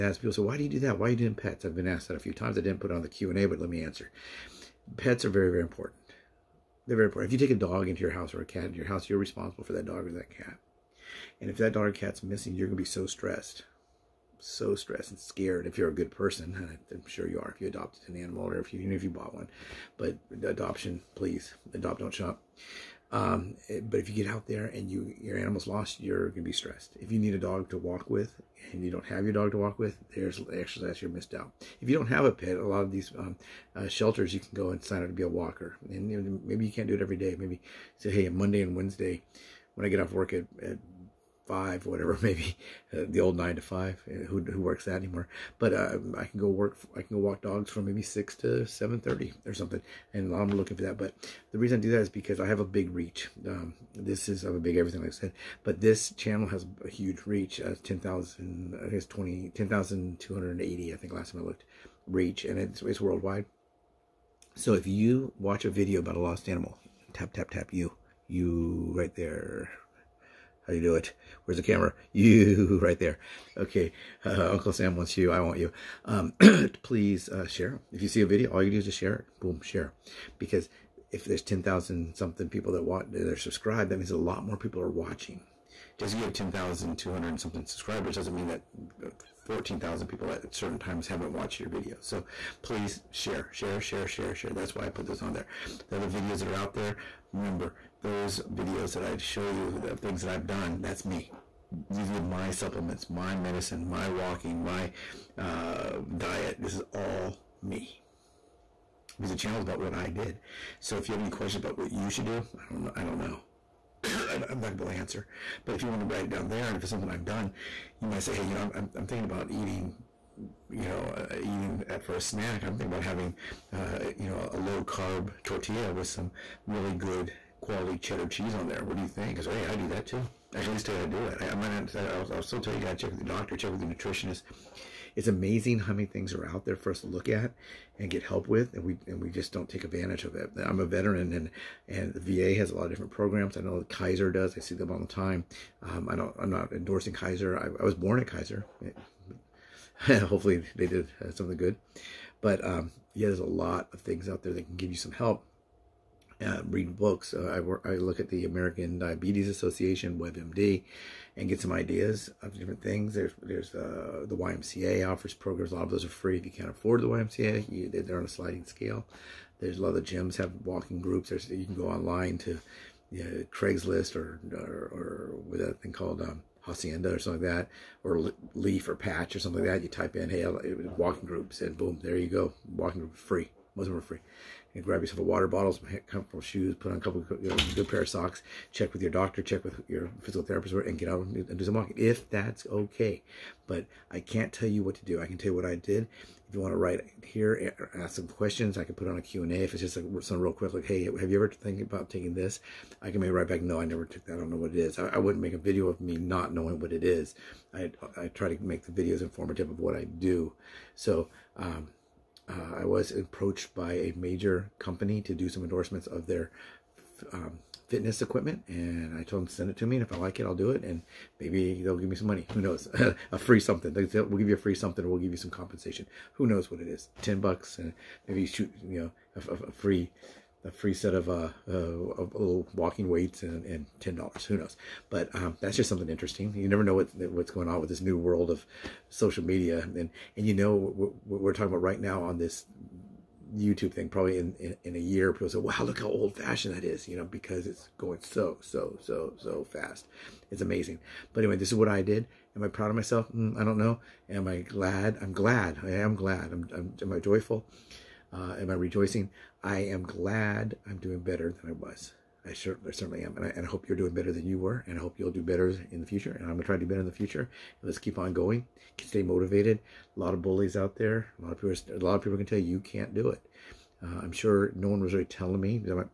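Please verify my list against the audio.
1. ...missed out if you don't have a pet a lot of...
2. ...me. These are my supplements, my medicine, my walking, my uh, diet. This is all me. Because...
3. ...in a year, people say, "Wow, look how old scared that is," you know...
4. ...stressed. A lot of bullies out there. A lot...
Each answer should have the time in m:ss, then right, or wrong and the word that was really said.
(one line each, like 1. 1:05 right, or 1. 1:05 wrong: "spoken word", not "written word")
1. 0:31 right
2. 1:41 right
3. 4:04 wrong: "fashioned", not "scared"
4. 4:29 wrong: "motivated", not "stressed".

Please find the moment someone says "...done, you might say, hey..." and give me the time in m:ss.
1:57.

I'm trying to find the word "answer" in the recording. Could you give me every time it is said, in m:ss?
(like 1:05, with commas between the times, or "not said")
0:03, 1:55.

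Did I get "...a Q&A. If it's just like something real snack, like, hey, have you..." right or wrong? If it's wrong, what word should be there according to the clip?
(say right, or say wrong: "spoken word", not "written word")
wrong: "quick", not "snack".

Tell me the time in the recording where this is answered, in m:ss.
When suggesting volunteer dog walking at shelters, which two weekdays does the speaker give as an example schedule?
0:38.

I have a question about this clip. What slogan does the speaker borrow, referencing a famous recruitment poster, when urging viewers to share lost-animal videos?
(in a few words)
Uncle Sam wants you.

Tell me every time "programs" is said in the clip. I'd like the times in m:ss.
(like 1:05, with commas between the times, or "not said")
2:23, 2:45.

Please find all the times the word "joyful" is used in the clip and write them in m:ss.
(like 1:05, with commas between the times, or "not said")
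4:17.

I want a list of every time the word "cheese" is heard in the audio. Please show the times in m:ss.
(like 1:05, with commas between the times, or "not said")
2:08.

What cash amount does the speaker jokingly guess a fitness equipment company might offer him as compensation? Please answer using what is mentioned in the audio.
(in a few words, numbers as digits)
10 dollars.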